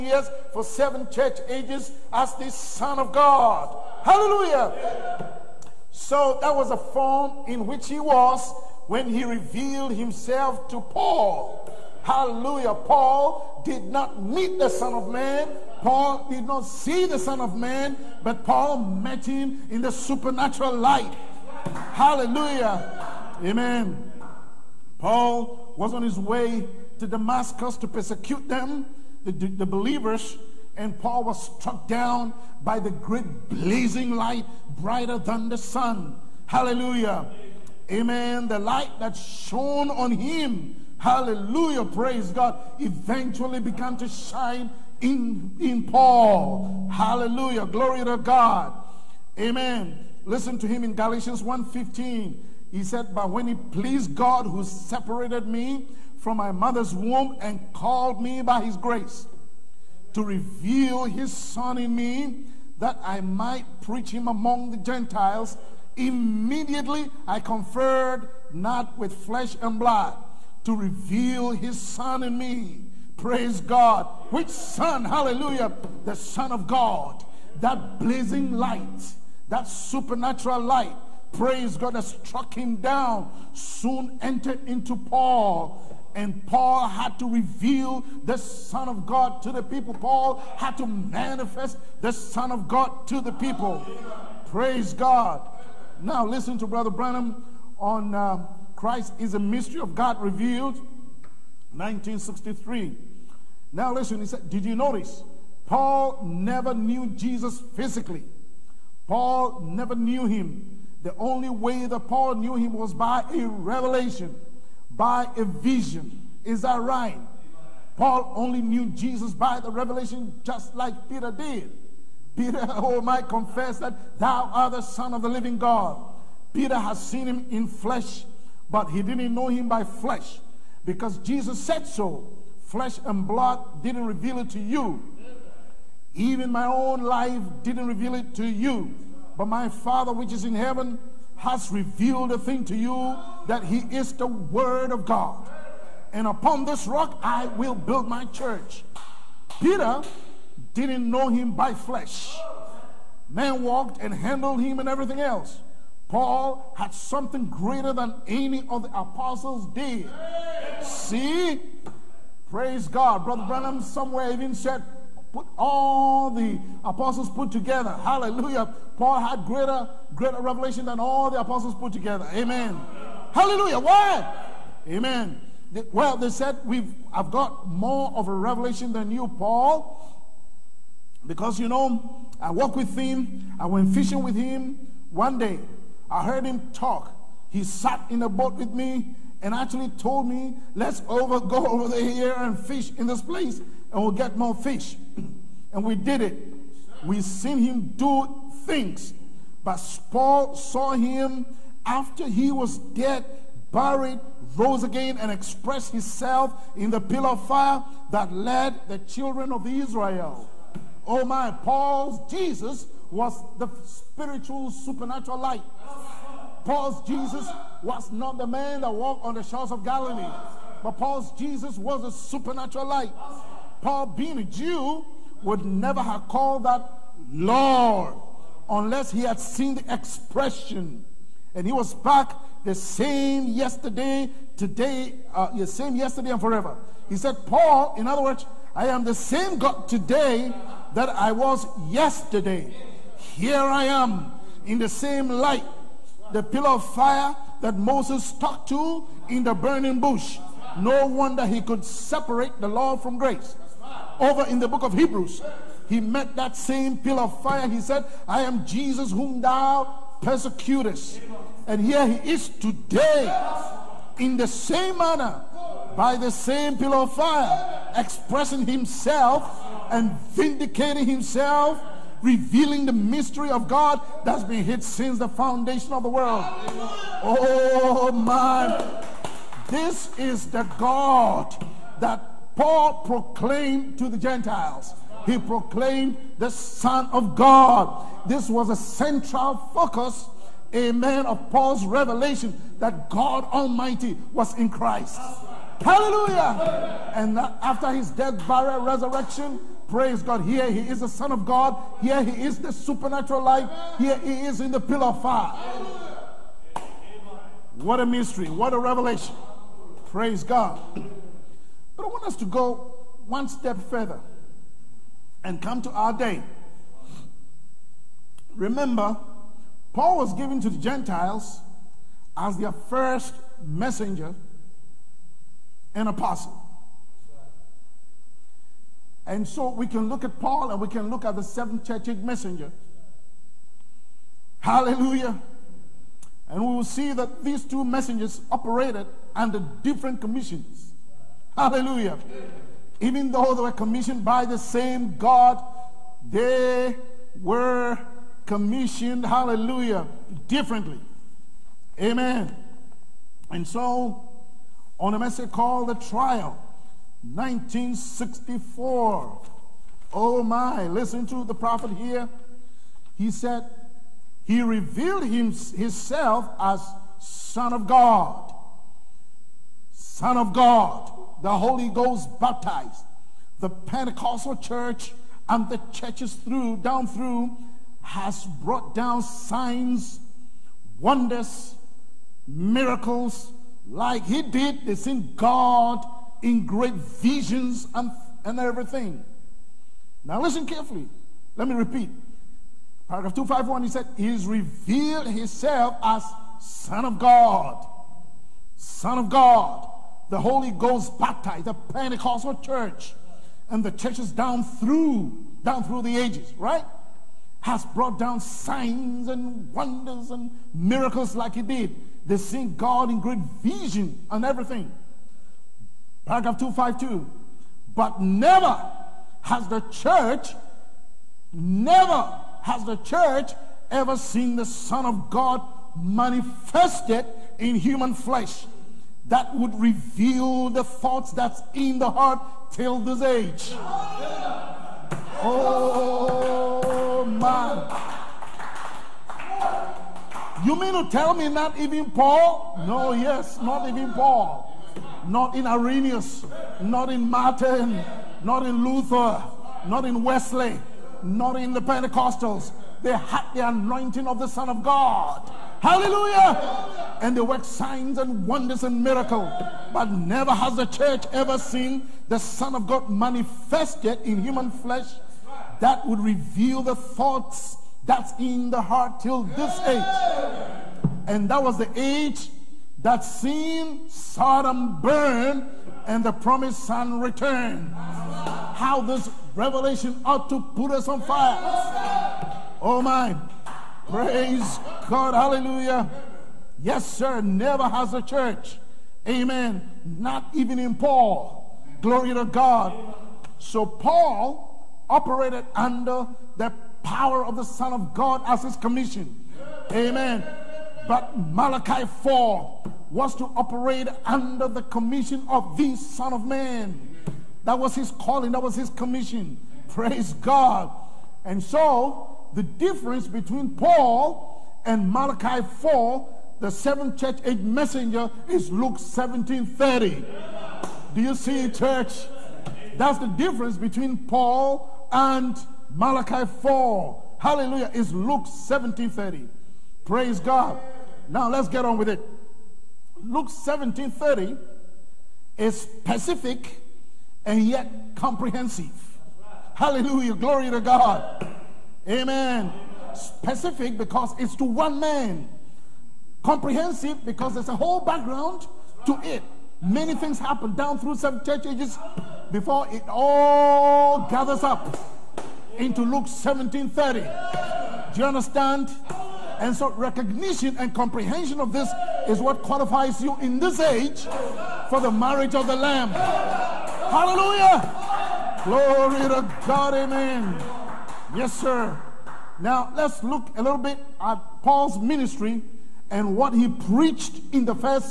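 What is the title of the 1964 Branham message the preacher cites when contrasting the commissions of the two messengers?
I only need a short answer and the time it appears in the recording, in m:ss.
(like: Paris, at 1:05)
The Trial, at 5:55.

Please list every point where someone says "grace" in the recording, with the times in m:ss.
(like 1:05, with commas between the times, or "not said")
0:58, 4:13.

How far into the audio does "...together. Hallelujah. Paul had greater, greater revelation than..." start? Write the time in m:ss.
2:47.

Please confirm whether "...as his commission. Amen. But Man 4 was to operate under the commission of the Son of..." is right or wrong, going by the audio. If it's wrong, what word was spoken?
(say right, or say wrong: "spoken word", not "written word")
wrong: "Malachi", not "Man".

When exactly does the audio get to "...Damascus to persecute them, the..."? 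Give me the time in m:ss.
0:27.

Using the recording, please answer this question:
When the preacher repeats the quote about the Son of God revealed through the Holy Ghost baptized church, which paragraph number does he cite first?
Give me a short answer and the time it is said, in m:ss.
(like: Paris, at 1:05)
251, at 6:33.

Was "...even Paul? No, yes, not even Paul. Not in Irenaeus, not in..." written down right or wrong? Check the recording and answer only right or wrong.
right.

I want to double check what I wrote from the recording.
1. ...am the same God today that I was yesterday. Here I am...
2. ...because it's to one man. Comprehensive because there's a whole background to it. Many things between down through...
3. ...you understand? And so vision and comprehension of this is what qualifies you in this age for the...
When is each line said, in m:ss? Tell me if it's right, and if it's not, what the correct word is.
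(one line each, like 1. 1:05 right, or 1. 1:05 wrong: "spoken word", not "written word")
1. 3:58 right
2. 9:03 wrong: "happen", not "between"
3. 9:18 wrong: "recognition", not "vision".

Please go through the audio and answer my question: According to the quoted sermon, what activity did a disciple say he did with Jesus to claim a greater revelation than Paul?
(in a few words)
fishing.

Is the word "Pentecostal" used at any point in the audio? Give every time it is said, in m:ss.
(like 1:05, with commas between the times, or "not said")
6:13, 6:41, 7:31.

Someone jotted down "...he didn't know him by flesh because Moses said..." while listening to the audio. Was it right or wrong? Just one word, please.
wrong.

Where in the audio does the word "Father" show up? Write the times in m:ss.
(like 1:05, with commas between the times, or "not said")
2:19.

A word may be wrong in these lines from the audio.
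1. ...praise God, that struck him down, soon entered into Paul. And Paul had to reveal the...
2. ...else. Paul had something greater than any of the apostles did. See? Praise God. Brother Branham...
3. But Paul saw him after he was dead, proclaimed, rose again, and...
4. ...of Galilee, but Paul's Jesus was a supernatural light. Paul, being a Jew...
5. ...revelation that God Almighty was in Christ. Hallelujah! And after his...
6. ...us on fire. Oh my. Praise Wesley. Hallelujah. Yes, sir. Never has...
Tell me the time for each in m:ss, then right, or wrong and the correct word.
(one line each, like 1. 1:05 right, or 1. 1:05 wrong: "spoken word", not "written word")
1. 1:21 right
2. 2:35 right
3. 3:19 wrong: "buried", not "proclaimed"
4. 3:39 right
5. 4:51 right
6. 8:00 wrong: "God", not "Wesley".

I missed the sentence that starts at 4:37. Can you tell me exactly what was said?
Oh man, this is the God that Paul proclaimed to the Gentiles.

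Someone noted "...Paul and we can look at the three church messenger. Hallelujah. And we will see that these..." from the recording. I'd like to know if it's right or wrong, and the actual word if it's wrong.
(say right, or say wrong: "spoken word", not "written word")
wrong: "seven", not "three".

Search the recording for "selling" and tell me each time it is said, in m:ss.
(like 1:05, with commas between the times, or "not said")
not said.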